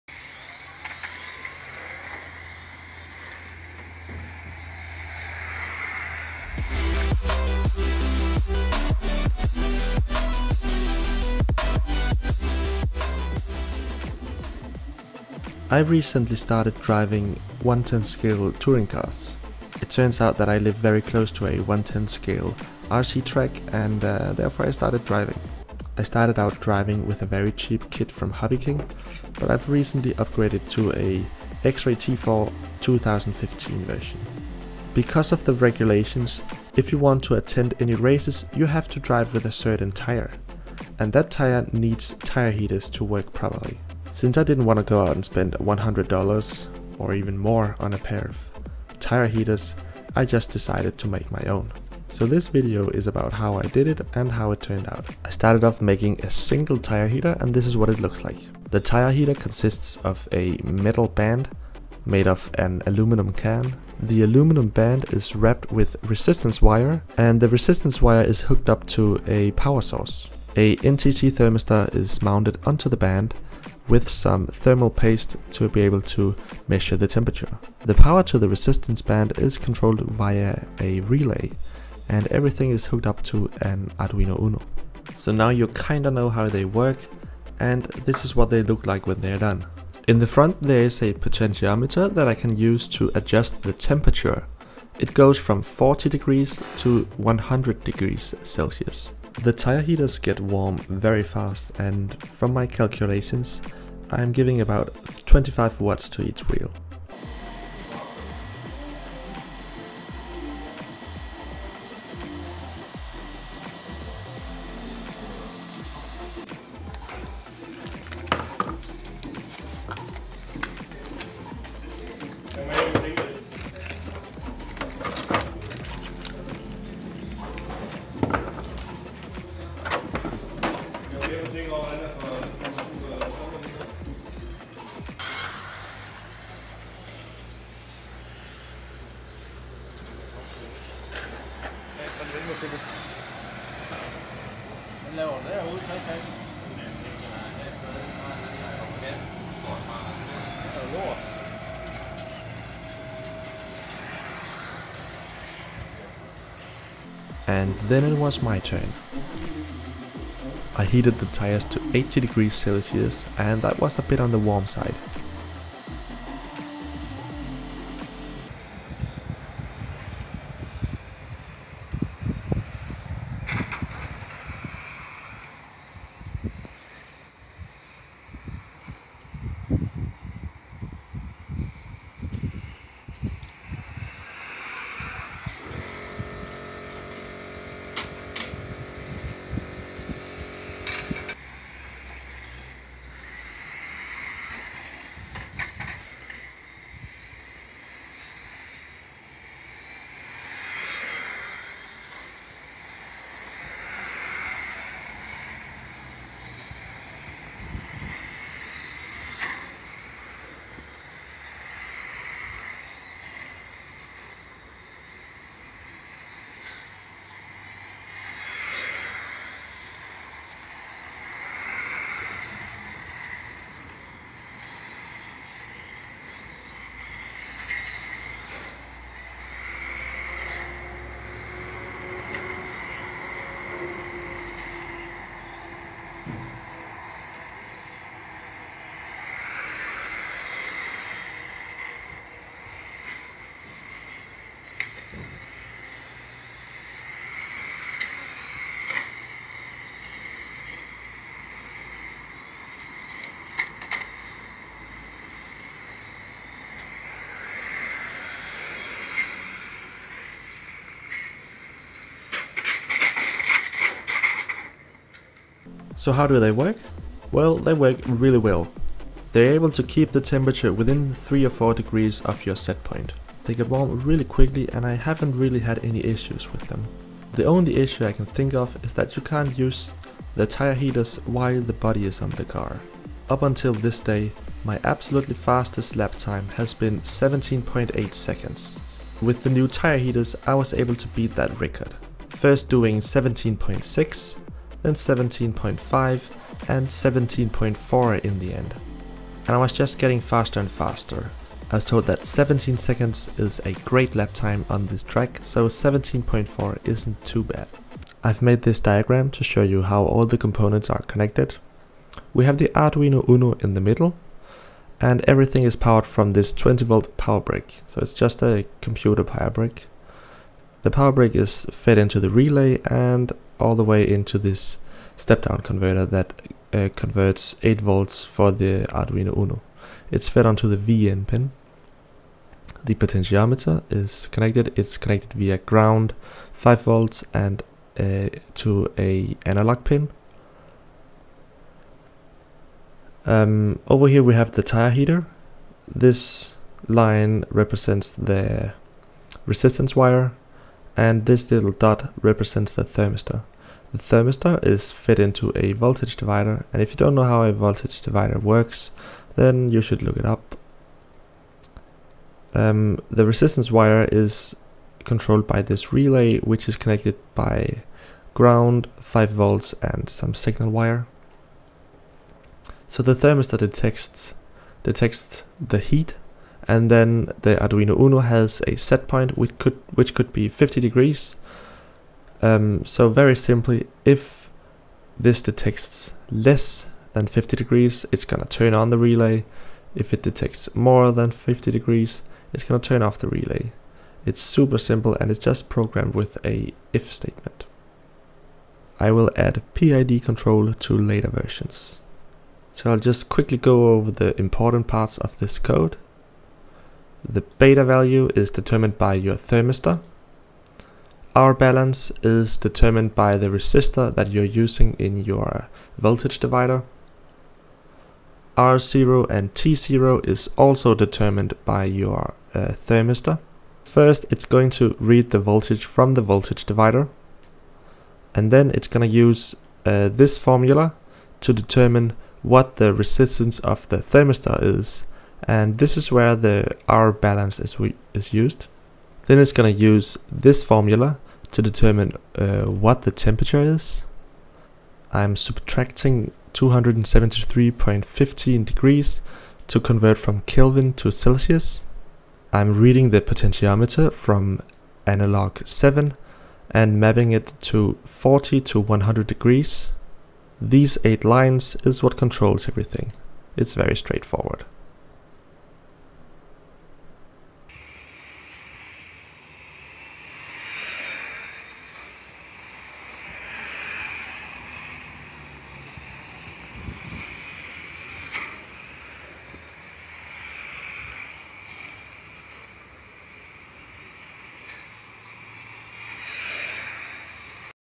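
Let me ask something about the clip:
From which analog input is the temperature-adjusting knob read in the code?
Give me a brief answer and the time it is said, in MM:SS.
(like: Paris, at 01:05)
analog 7, at 07:35.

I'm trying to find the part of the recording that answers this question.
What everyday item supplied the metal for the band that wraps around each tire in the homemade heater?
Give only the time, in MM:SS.
01:02.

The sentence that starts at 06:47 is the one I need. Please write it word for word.
The beta value is determined by your thermistor.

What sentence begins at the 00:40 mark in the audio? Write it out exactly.
And that tire needs tire heaters to work properly.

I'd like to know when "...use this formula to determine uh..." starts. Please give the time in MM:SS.
07:19.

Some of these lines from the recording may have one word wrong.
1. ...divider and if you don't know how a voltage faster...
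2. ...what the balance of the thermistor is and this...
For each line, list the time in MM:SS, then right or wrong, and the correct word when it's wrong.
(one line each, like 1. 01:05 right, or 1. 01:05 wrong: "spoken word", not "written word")
1. 05:56 wrong: "divider", not "faster"
2. 07:12 wrong: "resistance", not "balance".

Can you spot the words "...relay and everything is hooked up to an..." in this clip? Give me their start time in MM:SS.
01:21.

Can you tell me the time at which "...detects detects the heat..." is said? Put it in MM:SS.
06:13.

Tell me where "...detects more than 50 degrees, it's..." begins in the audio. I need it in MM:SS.
06:30.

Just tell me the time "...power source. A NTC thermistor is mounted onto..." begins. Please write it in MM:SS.
01:09.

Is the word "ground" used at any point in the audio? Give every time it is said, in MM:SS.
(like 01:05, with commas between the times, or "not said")
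05:35, 06:08.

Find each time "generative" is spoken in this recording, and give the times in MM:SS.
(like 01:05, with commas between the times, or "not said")
not said.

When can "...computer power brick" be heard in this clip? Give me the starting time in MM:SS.
05:18.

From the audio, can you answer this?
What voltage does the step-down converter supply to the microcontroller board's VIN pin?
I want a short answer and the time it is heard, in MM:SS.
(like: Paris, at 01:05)
8 volts, at 05:27.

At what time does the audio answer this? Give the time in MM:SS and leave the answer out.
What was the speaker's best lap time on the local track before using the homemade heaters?
04:47.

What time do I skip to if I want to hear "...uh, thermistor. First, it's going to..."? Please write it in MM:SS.
07:02.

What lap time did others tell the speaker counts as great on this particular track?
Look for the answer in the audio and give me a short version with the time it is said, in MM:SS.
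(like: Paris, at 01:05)
17 seconds, at 05:02.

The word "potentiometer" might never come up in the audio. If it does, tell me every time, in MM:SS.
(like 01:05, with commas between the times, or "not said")
01:31, 05:32, 07:33.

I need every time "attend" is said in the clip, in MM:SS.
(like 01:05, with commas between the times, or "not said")
00:37.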